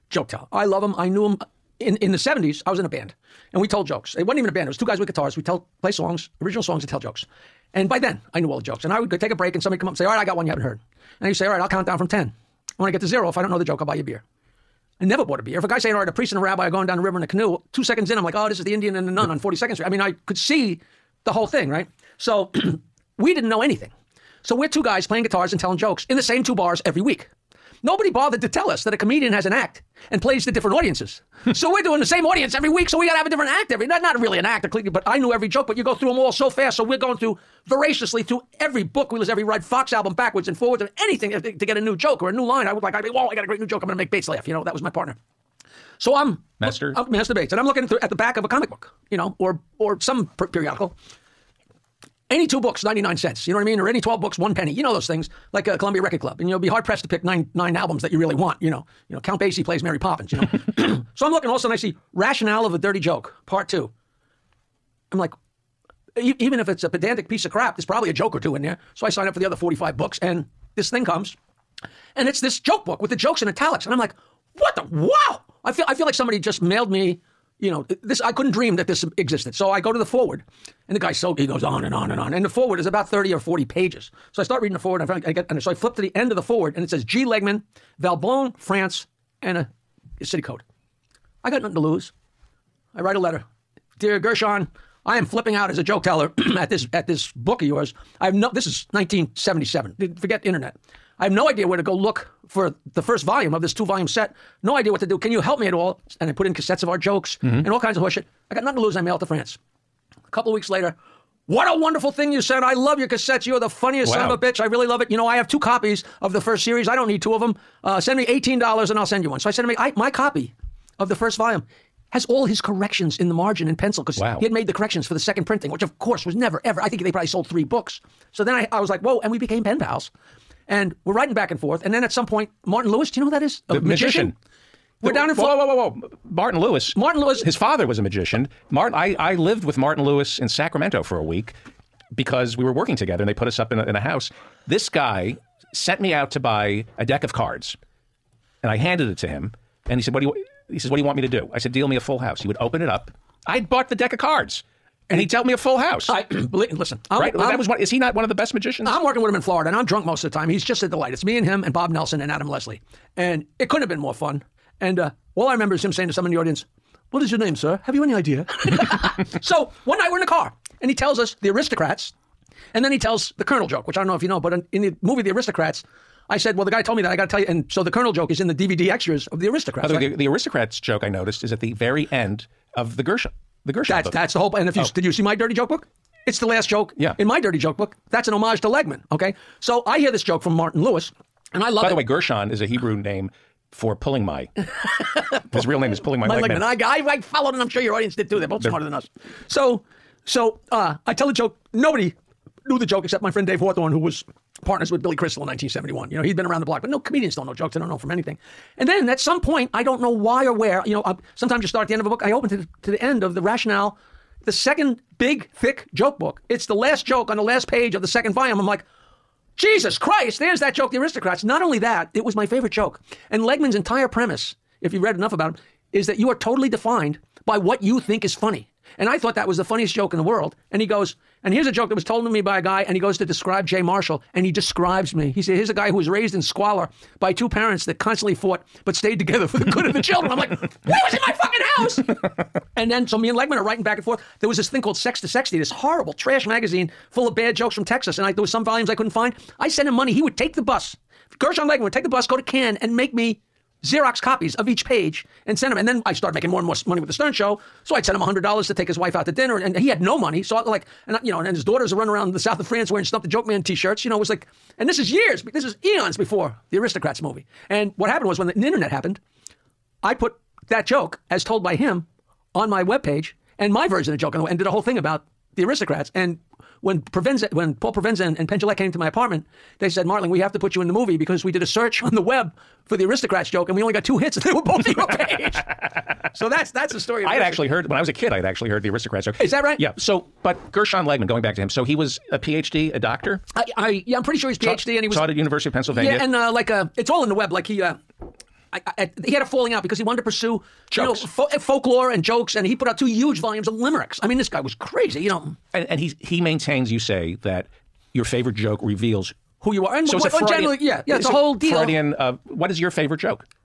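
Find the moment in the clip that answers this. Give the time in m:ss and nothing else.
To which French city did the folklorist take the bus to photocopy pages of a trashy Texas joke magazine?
4:12.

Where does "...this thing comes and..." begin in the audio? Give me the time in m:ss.
1:10.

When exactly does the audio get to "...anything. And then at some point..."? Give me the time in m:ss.
3:28.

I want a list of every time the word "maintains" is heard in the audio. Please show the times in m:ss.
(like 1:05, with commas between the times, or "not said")
5:06.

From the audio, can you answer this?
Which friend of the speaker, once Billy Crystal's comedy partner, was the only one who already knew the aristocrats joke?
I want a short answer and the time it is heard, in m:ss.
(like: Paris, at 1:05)
Dave Hawthorne, at 3:23.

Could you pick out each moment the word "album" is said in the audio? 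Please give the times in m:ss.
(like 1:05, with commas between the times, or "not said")
0:39, 0:57.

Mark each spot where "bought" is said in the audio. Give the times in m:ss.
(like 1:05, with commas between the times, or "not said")
0:15, 2:33.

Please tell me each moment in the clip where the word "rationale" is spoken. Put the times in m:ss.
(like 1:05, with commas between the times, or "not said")
1:02, 3:33.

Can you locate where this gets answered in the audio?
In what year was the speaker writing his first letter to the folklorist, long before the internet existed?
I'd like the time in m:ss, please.
1:38.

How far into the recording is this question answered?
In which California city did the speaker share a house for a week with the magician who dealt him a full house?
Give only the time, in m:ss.
2:20.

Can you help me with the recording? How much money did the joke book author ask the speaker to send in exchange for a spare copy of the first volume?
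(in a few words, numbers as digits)
$18.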